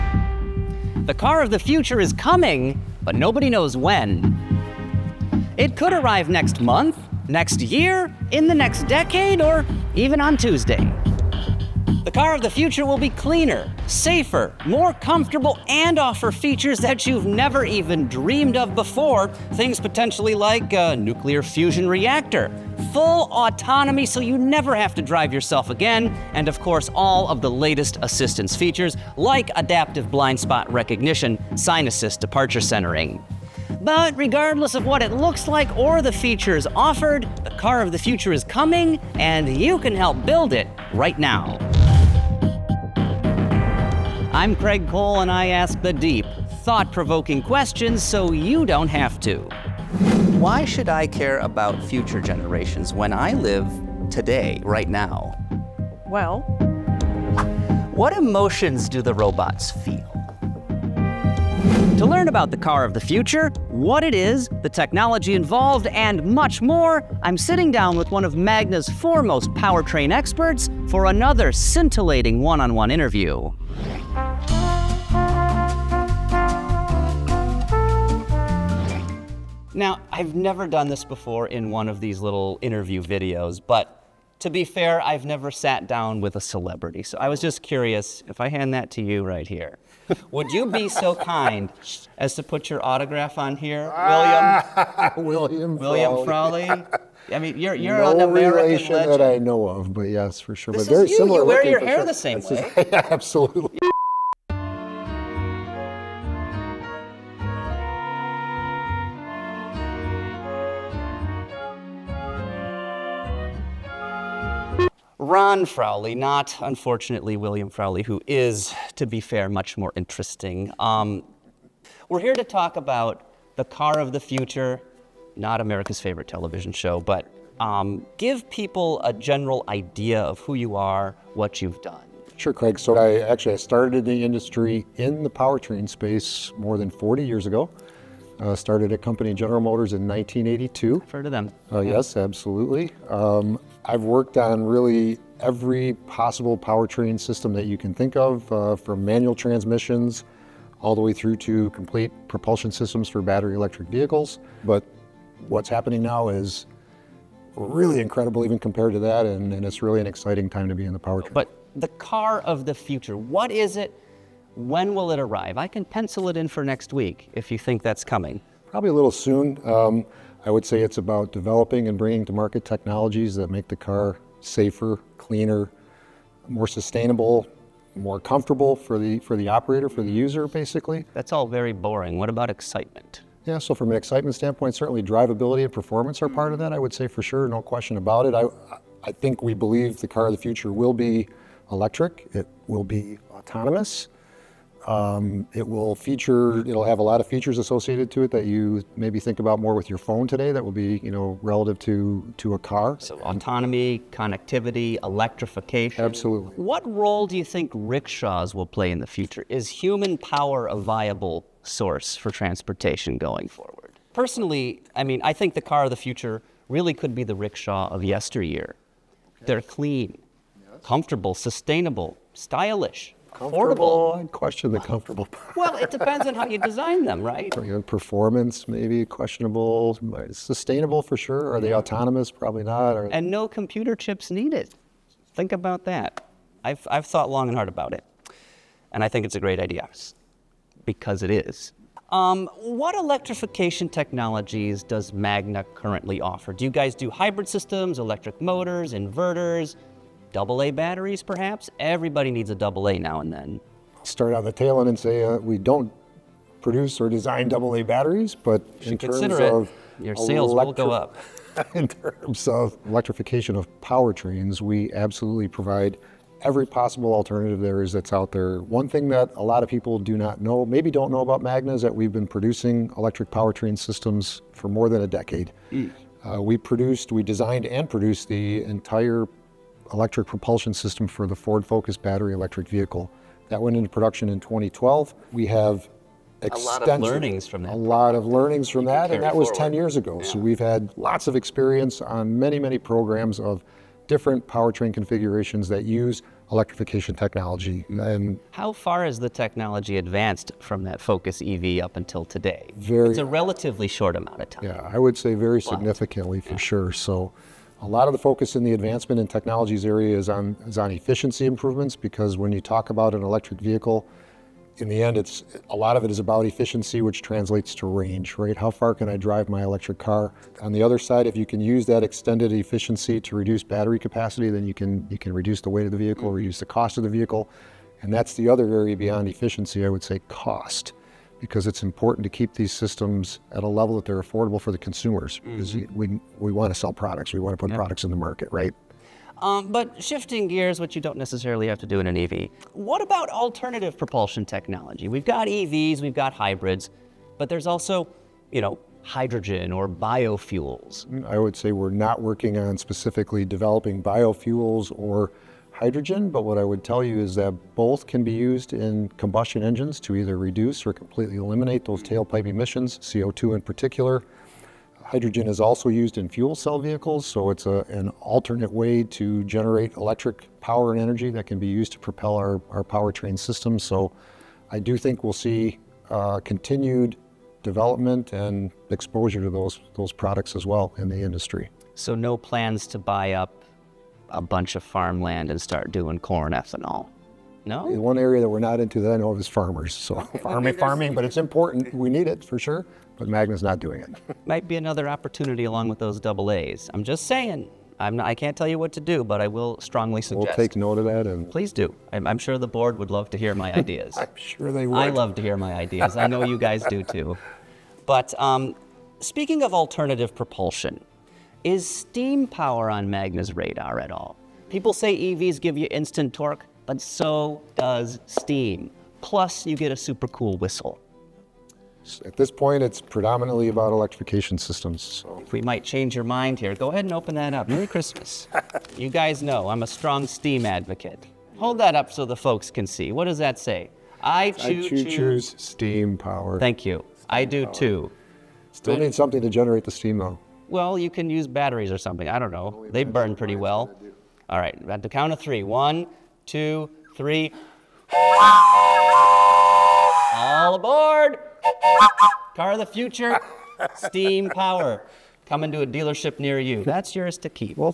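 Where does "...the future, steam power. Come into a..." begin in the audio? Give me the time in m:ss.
7:32.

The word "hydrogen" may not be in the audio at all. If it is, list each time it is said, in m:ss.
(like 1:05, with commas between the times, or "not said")
5:49, 5:55, 6:05.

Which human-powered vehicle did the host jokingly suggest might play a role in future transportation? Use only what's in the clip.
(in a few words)
rickshaw.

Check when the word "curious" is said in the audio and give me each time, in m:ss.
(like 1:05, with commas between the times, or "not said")
1:27.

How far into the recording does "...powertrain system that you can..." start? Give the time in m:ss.
2:26.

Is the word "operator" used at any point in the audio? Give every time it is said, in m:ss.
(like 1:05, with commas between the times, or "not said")
2:59.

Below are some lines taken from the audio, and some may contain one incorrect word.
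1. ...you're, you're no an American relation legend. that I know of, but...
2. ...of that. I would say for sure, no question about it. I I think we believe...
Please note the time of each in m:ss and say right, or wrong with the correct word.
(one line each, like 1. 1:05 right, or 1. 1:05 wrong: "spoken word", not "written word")
1. 1:37 right
2. 3:06 right.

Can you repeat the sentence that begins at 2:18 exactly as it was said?
Uh, started a company, General Motors, in 1982.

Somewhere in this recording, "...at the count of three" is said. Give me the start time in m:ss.
7:24.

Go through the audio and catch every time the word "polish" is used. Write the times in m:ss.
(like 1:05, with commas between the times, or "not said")
not said.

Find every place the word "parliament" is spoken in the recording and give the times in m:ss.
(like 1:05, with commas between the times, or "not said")
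not said.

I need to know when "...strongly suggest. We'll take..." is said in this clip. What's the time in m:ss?
6:39.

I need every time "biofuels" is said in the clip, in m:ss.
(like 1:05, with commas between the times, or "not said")
5:49, 5:54.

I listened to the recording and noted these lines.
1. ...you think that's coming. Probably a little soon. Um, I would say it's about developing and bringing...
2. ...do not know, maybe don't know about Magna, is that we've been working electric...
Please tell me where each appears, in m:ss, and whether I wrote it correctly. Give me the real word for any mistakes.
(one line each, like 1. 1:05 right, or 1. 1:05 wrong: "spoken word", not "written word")
1. 2:47 right
2. 4:29 wrong: "producing", not "working".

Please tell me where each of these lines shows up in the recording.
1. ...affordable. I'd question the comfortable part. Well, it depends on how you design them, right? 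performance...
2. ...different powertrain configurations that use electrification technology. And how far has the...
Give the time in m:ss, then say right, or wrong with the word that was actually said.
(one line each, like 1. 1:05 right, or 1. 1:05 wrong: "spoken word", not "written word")
1. 3:43 right
2. 4:54 right.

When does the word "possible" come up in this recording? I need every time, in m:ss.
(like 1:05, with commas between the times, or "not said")
2:26, 4:26.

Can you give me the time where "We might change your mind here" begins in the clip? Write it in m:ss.
7:05.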